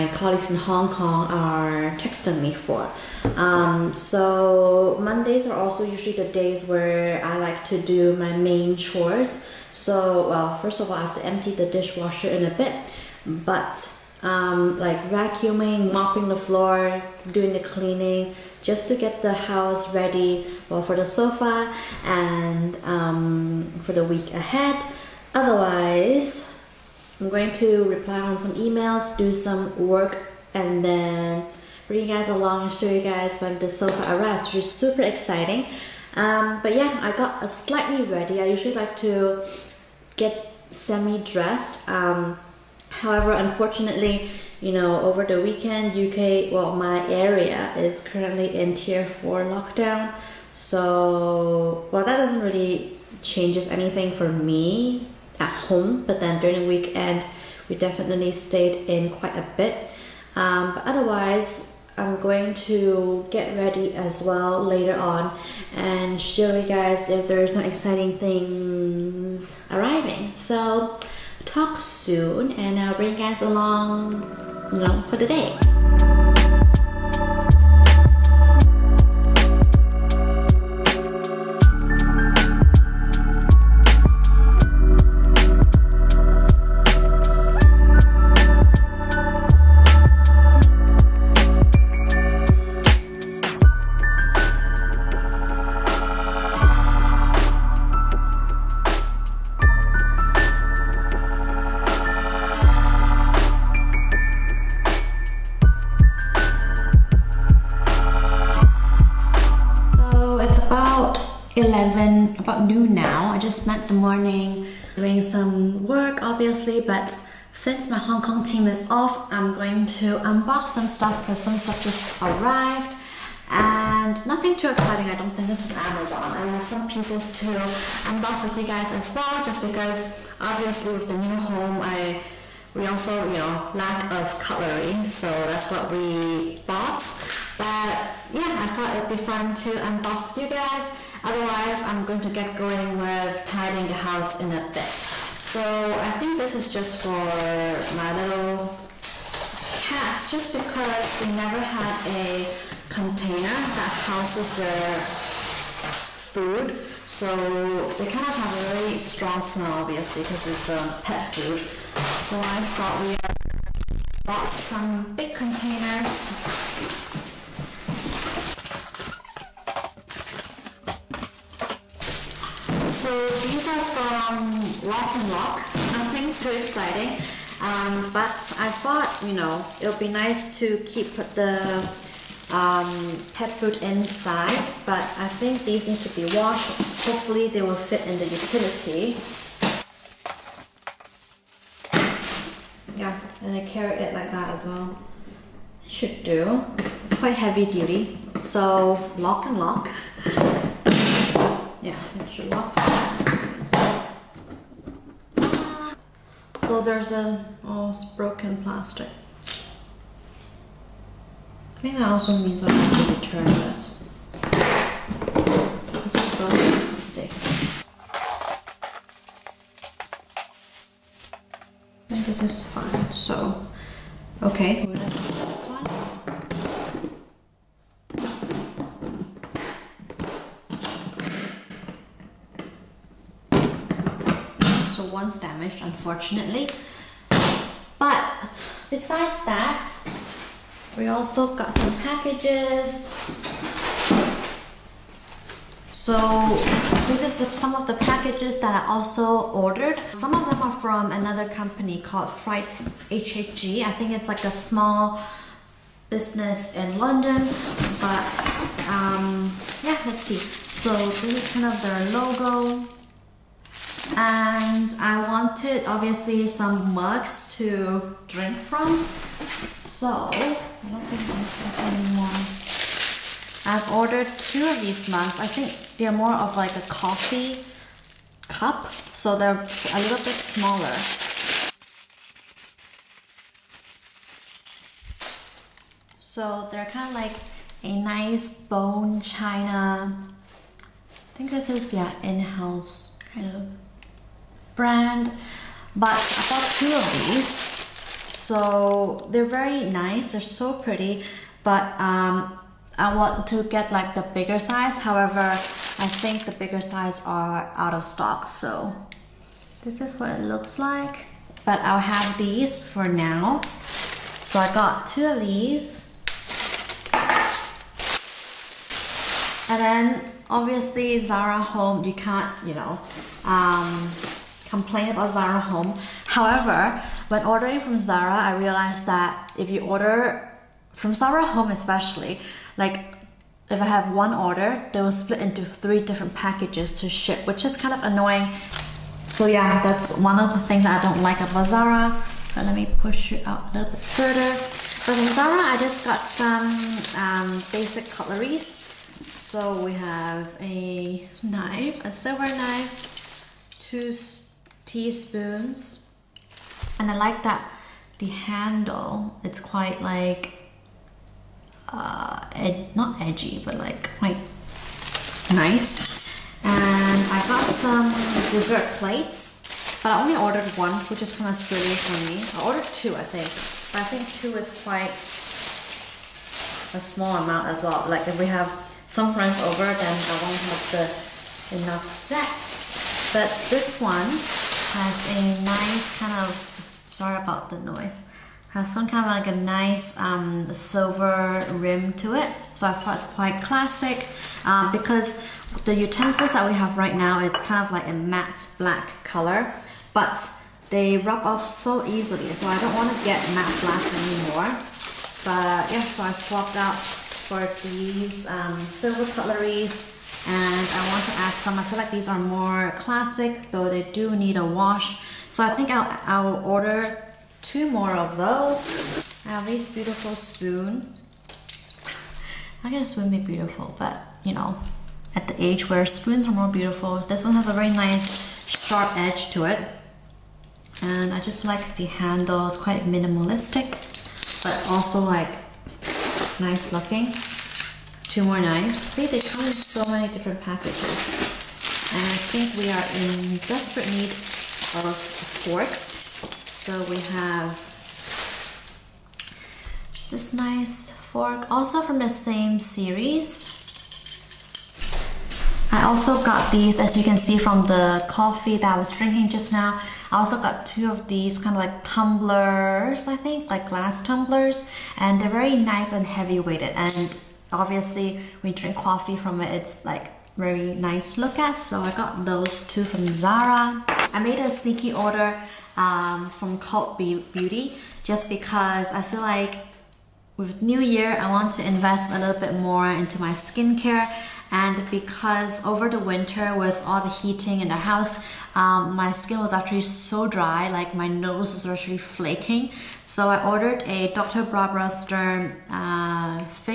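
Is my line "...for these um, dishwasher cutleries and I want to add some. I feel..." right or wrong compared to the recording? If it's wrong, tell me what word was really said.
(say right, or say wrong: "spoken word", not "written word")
wrong: "silver", not "dishwasher".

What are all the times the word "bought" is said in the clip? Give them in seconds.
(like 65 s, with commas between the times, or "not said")
136 s, 164 s, 296 s.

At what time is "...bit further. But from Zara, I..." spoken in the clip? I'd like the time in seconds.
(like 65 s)
343 s.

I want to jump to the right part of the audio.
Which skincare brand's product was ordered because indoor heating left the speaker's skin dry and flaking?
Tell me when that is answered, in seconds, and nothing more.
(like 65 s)
494 s.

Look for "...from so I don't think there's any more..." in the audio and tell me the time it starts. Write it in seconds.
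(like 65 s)
268 s.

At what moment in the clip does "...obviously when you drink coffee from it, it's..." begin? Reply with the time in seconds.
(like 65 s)
467 s.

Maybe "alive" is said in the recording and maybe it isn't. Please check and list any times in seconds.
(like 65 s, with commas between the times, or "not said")
not said.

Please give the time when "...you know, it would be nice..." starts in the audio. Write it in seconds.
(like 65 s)
179 s.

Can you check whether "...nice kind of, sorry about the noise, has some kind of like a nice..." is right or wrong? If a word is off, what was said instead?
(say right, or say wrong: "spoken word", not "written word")
right.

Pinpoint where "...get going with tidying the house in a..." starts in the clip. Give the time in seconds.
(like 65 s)
142 s.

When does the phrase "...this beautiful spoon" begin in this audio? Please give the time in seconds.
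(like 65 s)
419 s.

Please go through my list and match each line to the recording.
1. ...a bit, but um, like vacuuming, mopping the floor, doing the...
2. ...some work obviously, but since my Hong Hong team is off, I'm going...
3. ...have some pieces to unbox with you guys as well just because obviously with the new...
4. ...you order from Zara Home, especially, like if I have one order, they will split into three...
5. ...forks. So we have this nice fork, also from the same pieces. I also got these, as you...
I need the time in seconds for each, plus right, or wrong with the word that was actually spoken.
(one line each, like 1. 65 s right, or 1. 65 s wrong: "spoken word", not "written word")
1. 12 s right
2. 115 s wrong: "Kong", not "Hong"
3. 126 s right
4. 329 s right
5. 445 s wrong: "series", not "pieces".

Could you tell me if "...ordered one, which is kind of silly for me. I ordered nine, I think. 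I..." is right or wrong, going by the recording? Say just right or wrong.
wrong.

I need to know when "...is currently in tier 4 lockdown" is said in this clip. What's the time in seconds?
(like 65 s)
47 s.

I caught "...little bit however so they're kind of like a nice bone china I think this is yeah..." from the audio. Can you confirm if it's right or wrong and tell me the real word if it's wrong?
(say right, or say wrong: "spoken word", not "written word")
wrong: "smaller", not "however".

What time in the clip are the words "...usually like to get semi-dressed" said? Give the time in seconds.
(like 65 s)
38 s.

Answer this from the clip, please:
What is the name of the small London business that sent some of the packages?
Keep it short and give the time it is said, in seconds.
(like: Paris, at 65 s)
Freight HHG, at 252 s.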